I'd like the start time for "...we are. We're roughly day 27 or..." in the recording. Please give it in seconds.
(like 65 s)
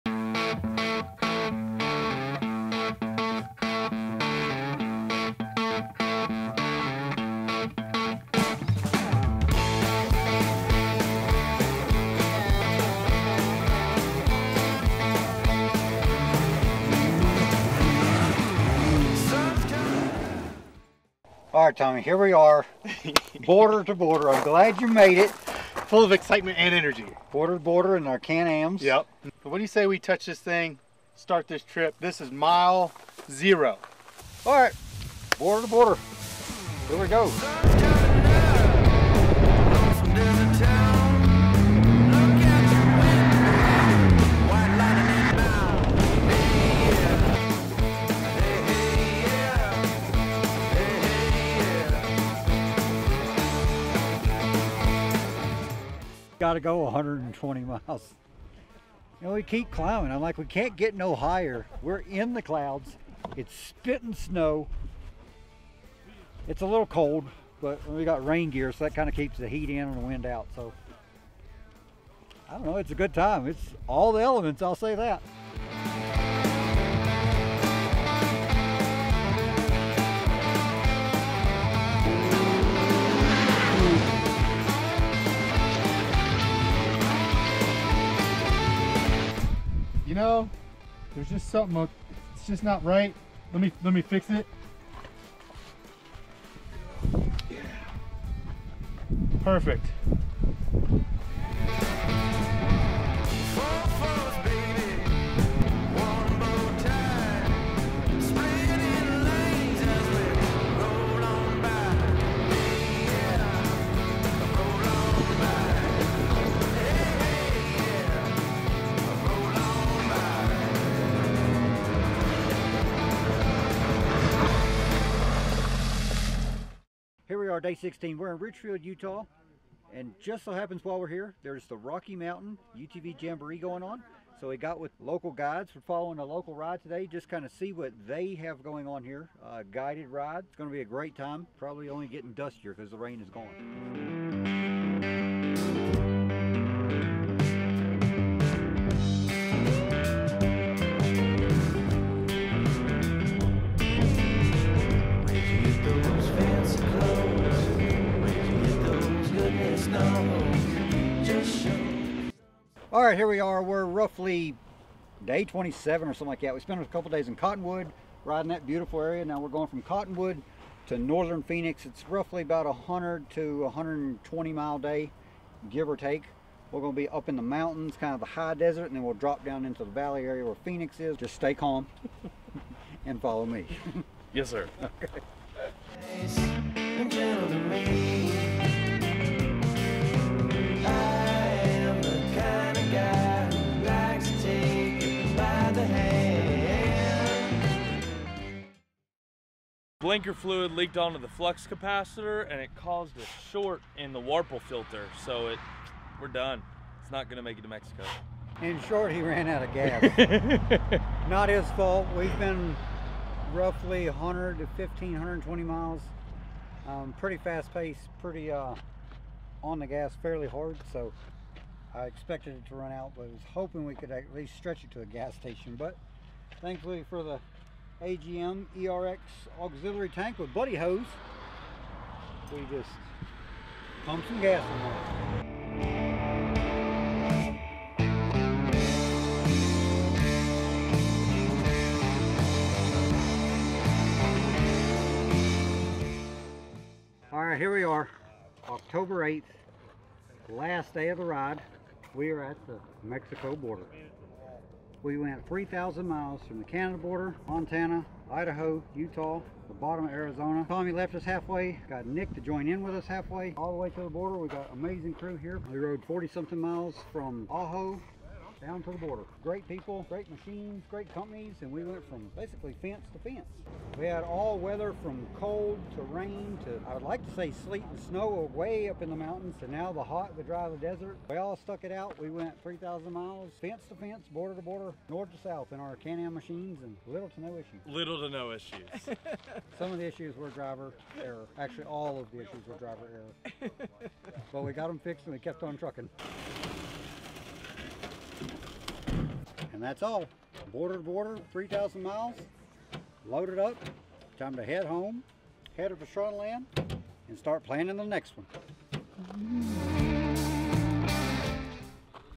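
163 s.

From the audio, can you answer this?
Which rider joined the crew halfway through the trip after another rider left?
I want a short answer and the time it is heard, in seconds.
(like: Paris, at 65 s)
Nick, at 262 s.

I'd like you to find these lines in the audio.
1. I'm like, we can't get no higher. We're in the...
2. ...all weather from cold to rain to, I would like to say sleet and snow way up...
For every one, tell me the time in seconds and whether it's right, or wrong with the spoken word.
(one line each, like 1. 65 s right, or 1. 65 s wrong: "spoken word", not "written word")
1. 60 s right
2. 274 s right.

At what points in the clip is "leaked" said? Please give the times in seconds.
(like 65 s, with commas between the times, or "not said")
200 s.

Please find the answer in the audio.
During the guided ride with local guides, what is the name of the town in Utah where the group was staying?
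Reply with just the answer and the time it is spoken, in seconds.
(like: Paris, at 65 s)
Richfield, at 128 s.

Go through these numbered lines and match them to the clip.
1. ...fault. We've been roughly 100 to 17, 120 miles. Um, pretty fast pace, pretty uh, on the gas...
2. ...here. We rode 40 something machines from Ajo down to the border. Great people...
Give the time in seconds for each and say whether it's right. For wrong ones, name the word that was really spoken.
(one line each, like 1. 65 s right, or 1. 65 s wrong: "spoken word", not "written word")
1. 211 s wrong: "15", not "17"
2. 265 s wrong: "miles", not "machines".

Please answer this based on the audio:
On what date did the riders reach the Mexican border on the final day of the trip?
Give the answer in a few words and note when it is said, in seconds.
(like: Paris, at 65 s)
October 8th, at 248 s.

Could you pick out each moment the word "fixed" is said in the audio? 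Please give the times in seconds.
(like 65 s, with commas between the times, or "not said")
295 s.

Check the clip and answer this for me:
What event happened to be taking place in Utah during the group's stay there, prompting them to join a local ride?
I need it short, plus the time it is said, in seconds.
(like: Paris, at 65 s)
Rocky Mountain UTV Jamboree, at 131 s.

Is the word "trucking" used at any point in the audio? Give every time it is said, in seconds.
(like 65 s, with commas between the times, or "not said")
295 s.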